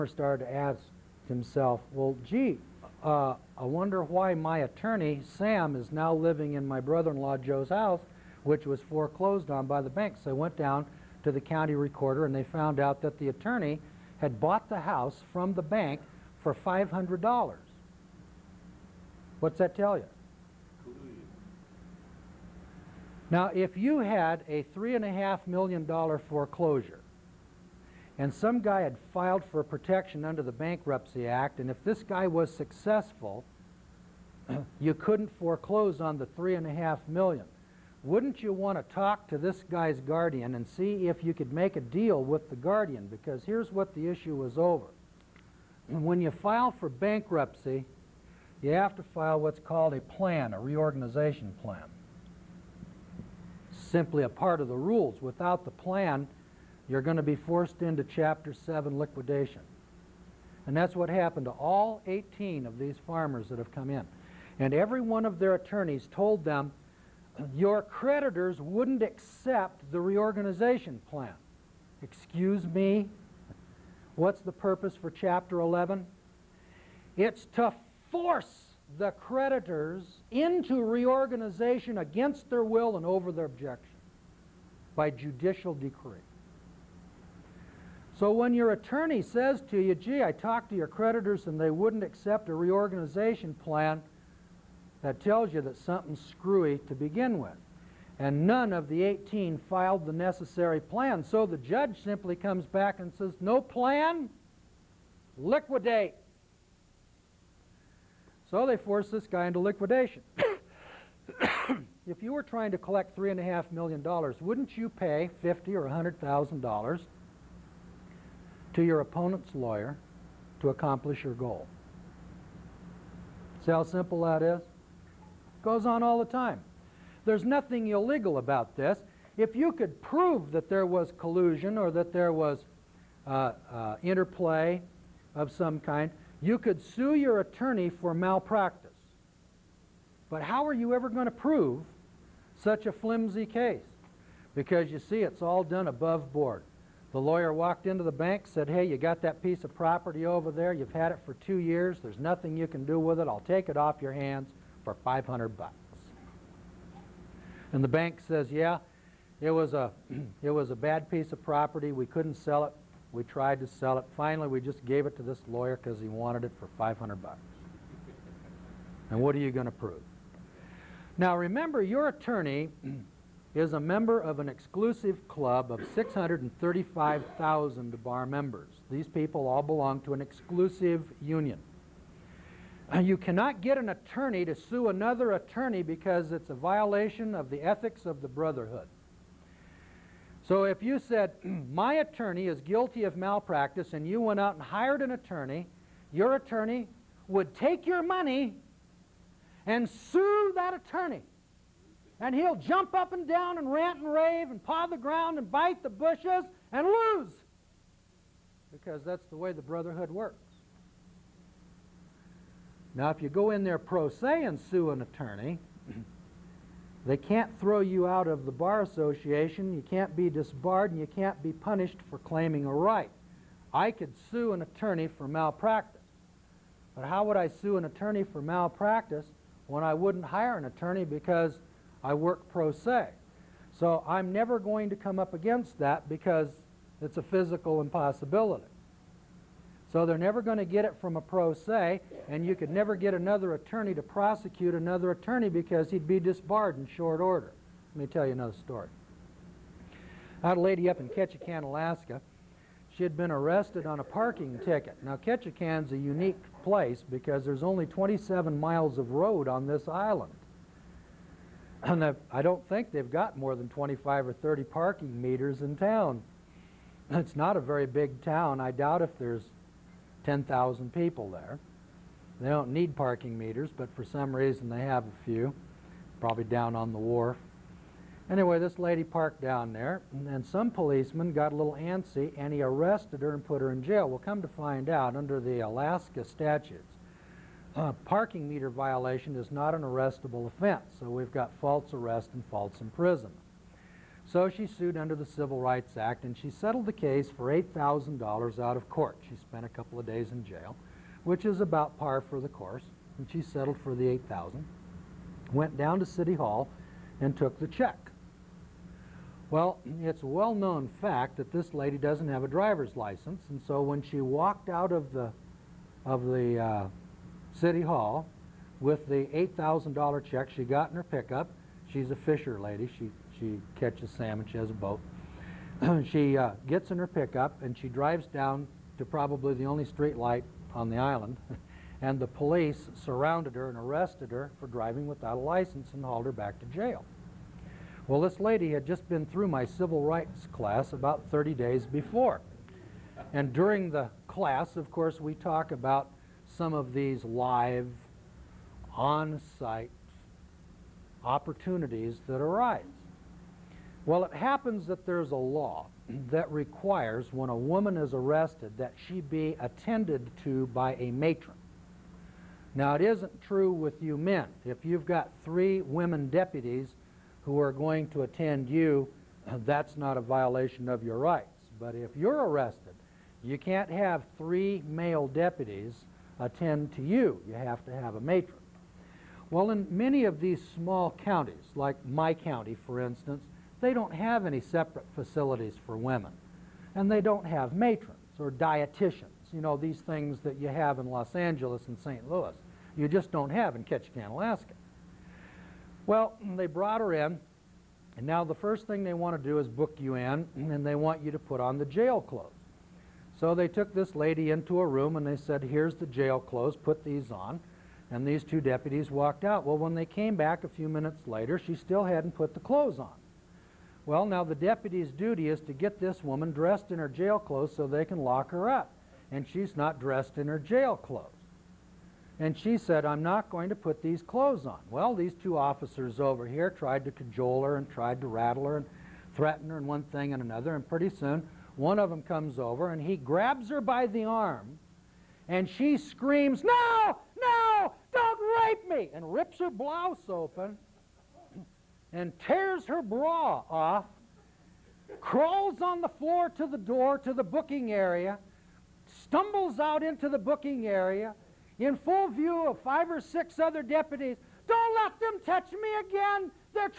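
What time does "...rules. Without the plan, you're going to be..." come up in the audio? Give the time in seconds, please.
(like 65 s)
54 s.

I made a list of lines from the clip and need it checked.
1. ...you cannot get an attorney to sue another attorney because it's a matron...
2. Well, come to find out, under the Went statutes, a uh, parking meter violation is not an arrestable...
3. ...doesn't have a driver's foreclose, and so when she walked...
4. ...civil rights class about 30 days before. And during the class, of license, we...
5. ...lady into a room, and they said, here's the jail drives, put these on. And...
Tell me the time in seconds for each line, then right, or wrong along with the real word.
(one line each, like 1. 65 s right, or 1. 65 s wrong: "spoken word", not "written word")
1. 182 s wrong: "violation", not "matron"
2. 284 s wrong: "Alaska", not "Went"
3. 311 s wrong: "license", not "foreclose"
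4. 339 s wrong: "course", not "license"
5. 404 s wrong: "clothes", not "drives".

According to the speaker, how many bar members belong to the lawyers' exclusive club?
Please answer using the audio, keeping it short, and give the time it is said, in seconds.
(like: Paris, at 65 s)
635,000, at 175 s.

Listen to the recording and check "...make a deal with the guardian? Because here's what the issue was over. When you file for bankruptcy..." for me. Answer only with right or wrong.
right.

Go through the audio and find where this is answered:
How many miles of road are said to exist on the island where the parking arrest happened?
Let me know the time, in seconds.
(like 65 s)
257 s.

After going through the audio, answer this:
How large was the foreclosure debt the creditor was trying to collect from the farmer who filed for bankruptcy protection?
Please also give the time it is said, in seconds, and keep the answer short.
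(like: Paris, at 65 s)
$3.5 million, at 24 s.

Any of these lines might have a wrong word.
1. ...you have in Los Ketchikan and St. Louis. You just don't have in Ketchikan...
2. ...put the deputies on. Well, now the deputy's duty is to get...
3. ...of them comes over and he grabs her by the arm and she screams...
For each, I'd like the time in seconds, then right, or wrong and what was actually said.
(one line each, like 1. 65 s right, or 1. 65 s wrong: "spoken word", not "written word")
1. 390 s wrong: "Angeles", not "Ketchikan"
2. 412 s wrong: "clothes", not "deputies"
3. 431 s right.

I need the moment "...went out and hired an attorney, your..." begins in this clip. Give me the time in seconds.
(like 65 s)
194 s.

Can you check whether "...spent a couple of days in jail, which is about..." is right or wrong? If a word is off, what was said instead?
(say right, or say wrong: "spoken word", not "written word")
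right.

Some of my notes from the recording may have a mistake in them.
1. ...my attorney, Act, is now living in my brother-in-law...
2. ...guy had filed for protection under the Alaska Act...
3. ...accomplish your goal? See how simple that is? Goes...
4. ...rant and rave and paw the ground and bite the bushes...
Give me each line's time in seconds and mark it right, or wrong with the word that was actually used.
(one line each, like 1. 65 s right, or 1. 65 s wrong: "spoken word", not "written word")
1. 4 s wrong: "Sam", not "Act"
2. 28 s wrong: "Bankruptcy", not "Alaska"
3. 120 s right
4. 203 s right.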